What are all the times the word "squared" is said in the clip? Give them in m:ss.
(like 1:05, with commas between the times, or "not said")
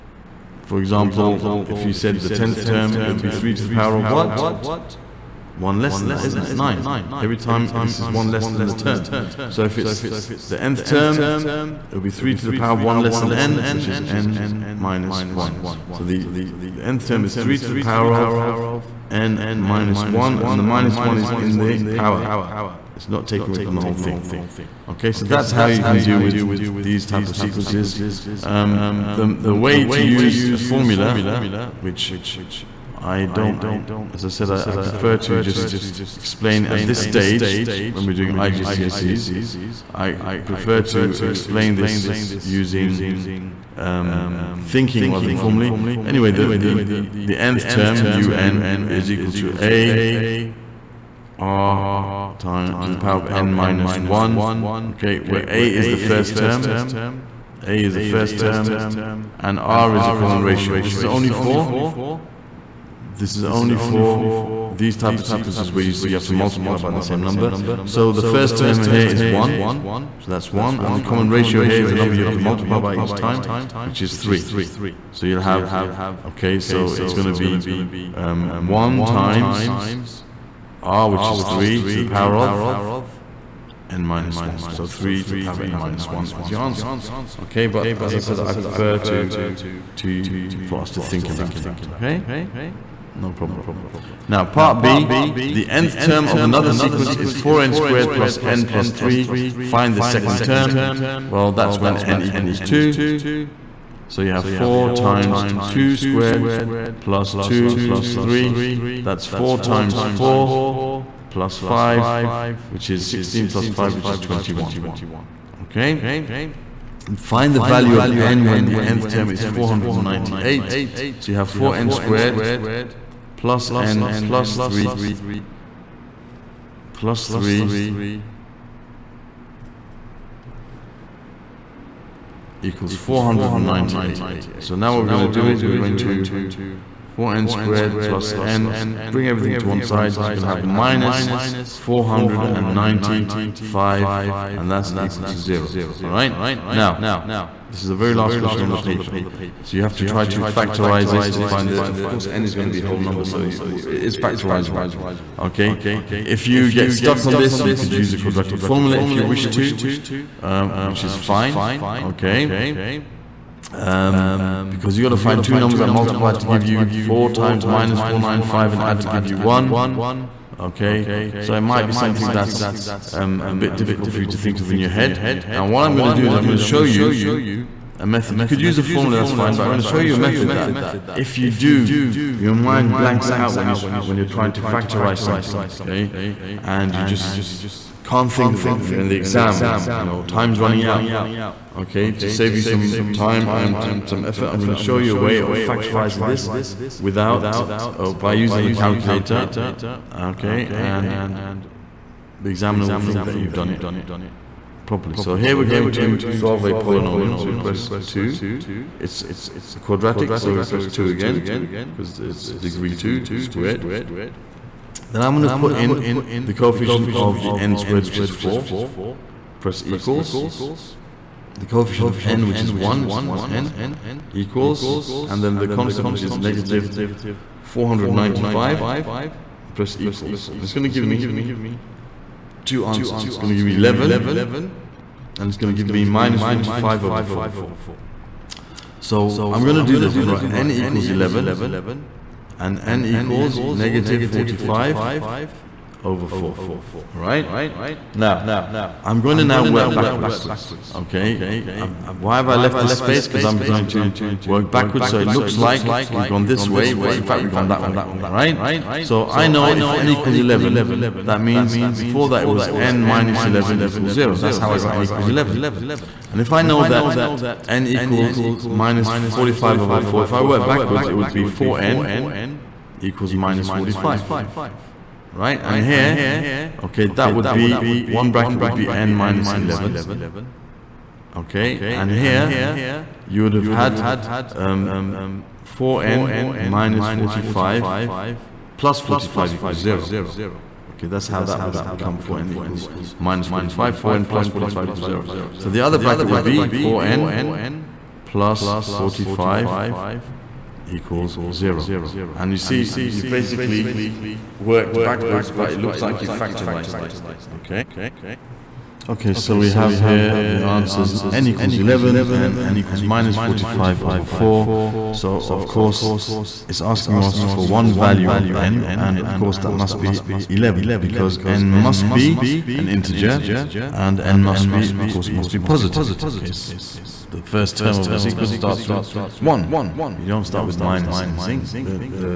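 1:37, 1:45, 2:01, 2:17, 3:33, 3:37.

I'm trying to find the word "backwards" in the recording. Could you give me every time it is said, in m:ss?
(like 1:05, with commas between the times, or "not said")
4:09, 4:14, 4:30, 5:05.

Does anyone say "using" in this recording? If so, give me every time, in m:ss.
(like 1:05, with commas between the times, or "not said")
0:42, 3:18.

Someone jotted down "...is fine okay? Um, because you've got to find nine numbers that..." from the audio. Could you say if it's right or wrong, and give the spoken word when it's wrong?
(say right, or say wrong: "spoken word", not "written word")
wrong: "two", not "nine".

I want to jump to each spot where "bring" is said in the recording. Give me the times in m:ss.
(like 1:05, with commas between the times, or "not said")
2:19.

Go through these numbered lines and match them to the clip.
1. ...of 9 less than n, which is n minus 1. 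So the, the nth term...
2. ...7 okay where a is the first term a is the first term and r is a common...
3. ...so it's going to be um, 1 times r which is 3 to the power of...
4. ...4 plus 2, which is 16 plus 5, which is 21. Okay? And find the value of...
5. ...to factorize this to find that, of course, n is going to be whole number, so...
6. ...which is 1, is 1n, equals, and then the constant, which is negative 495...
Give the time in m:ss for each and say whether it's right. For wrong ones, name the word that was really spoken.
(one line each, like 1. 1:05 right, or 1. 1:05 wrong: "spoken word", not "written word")
1. 0:12 wrong: "1", not "9"
2. 0:54 wrong: "1", not "7"
3. 1:16 right
4. 1:50 wrong: "5", not "2"
5. 2:30 right
6. 3:42 right.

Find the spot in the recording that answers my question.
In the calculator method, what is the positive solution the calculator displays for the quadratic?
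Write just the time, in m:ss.
3:53.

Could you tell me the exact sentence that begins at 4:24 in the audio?
That's how I got n equals 11.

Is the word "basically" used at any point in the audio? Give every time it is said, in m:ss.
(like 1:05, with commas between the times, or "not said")
5:03.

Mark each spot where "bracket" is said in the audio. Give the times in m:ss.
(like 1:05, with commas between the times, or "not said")
4:38, 4:55.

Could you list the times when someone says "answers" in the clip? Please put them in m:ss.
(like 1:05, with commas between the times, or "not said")
1:26, 3:52, 5:10.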